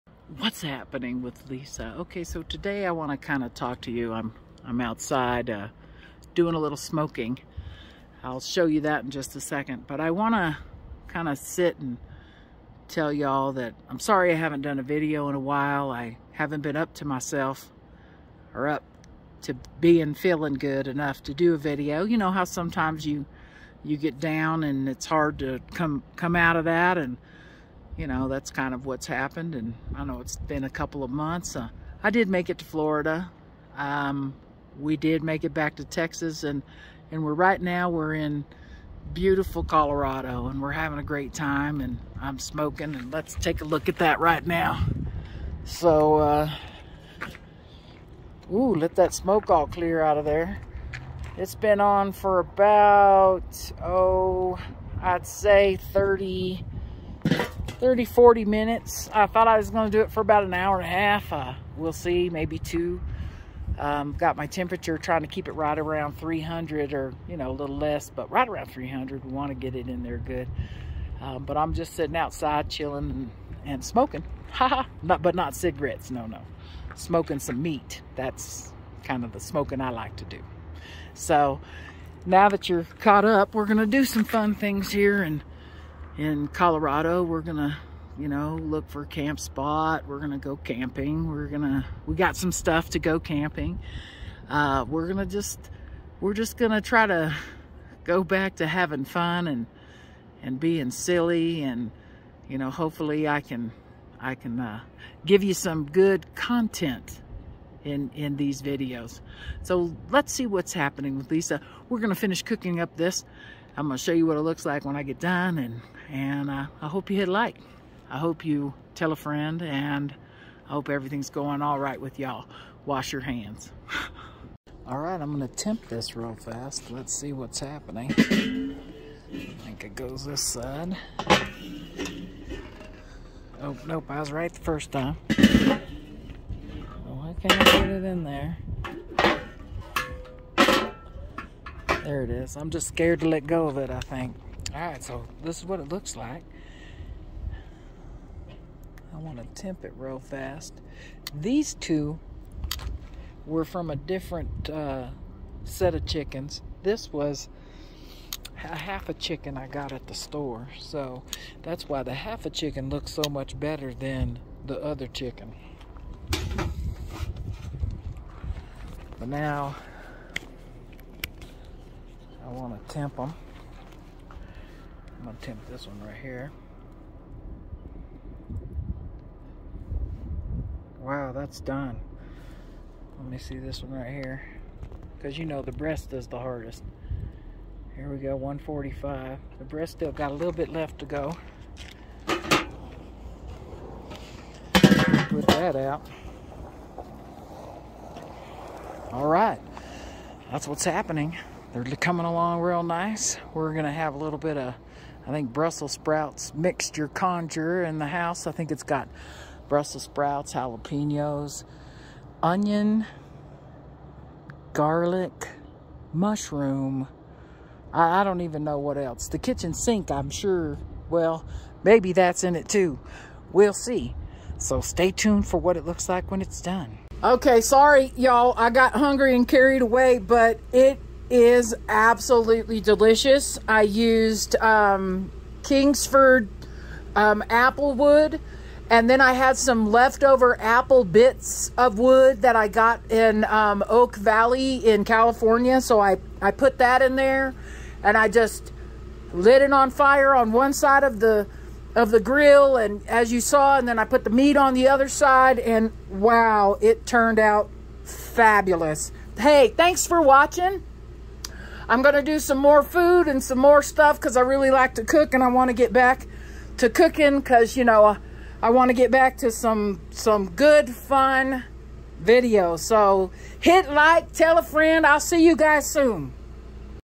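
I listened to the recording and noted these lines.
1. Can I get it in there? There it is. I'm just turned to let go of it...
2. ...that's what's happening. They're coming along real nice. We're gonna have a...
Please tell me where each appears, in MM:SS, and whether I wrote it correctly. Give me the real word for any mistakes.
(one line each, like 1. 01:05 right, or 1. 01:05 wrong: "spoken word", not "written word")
1. 02:17 wrong: "scared", not "turned"
2. 03:20 right.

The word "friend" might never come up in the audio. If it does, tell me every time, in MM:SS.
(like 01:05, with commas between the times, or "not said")
01:59, 04:34.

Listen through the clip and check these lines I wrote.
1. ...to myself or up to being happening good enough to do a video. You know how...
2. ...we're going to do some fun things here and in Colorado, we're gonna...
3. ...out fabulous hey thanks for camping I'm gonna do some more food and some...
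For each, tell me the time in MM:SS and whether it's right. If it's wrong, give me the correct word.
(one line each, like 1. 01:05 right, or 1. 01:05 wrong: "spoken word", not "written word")
1. 00:16 wrong: "feeling", not "happening"
2. 01:23 right
3. 04:17 wrong: "watching", not "camping".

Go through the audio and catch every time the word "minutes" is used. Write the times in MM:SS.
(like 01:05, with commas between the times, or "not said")
00:58.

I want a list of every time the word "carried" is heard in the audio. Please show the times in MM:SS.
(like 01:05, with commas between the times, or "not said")
03:49.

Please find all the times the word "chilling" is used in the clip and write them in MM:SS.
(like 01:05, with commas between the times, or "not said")
01:12.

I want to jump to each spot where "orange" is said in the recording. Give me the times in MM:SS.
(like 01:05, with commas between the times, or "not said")
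not said.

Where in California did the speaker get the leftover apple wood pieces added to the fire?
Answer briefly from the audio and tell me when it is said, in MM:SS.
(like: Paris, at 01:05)
Oak Valley, at 04:03.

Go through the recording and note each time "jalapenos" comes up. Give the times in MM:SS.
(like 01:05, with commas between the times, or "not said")
03:30.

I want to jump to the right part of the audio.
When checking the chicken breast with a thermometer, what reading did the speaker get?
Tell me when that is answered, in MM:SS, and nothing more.
03:08.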